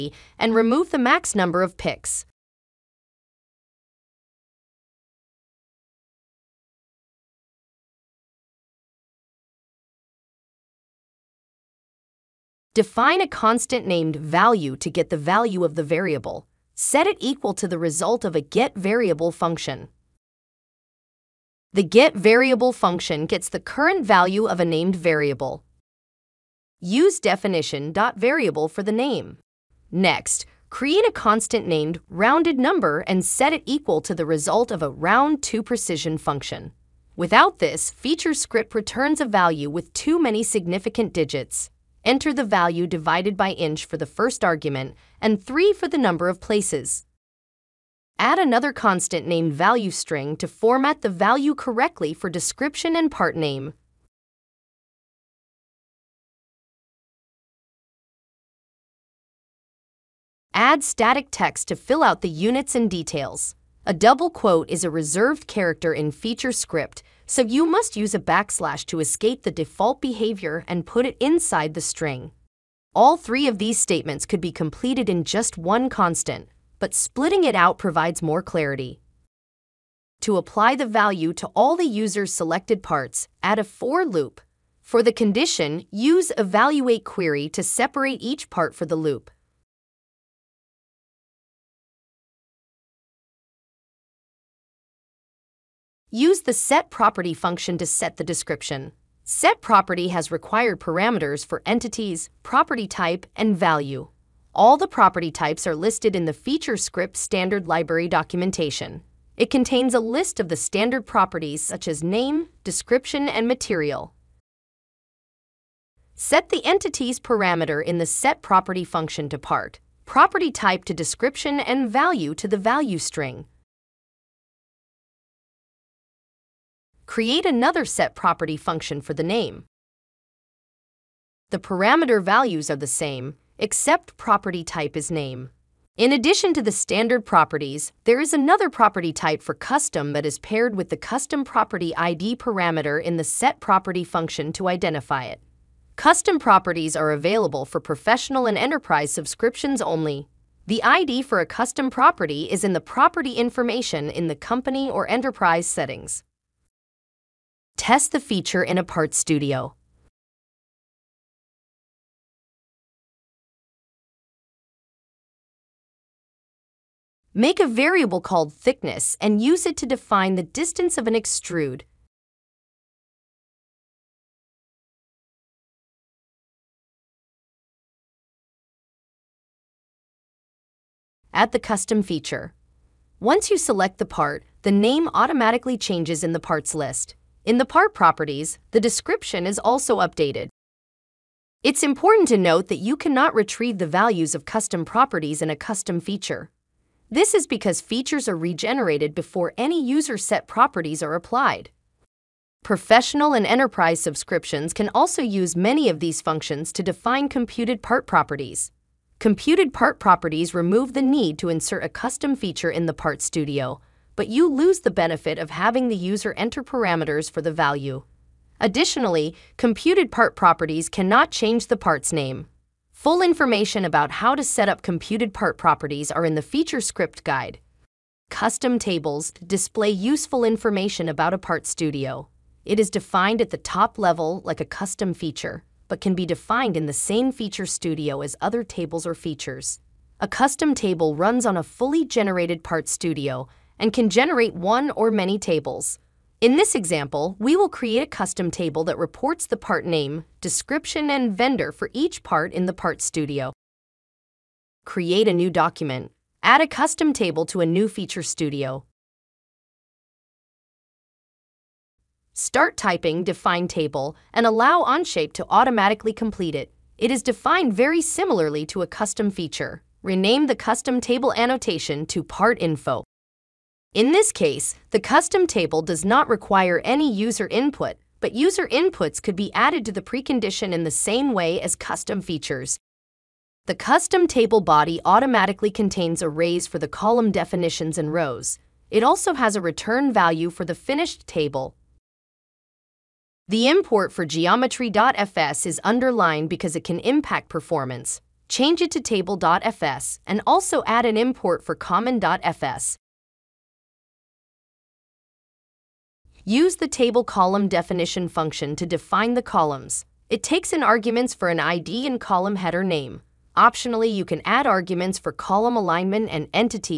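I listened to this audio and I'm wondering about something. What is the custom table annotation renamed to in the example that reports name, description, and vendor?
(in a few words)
Part Info.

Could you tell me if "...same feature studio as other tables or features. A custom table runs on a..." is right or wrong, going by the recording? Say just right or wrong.
right.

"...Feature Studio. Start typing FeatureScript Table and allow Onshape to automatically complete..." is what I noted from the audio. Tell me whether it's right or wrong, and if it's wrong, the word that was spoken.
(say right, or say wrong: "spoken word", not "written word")
wrong: "Define", not "FeatureScript".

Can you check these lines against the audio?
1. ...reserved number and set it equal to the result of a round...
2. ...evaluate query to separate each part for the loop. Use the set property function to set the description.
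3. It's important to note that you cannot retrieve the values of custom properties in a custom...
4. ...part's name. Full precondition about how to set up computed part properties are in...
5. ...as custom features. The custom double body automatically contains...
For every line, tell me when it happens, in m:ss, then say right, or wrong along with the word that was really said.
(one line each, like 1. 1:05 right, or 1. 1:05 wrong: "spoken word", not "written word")
1. 0:32 wrong: "rounded", not "reserved"
2. 1:26 right
3. 3:11 right
4. 3:41 wrong: "information", not "precondition"
5. 4:41 wrong: "table", not "double".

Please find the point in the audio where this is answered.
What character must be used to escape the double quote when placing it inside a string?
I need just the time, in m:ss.
1:08.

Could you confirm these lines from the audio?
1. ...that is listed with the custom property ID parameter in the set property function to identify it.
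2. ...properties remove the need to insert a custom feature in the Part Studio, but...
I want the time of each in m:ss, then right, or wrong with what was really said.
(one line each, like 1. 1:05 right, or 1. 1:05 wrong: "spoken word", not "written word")
1. 2:20 wrong: "paired", not "listed"
2. 3:29 right.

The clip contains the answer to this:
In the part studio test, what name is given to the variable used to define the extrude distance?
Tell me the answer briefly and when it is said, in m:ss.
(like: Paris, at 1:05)
thickness, at 2:48.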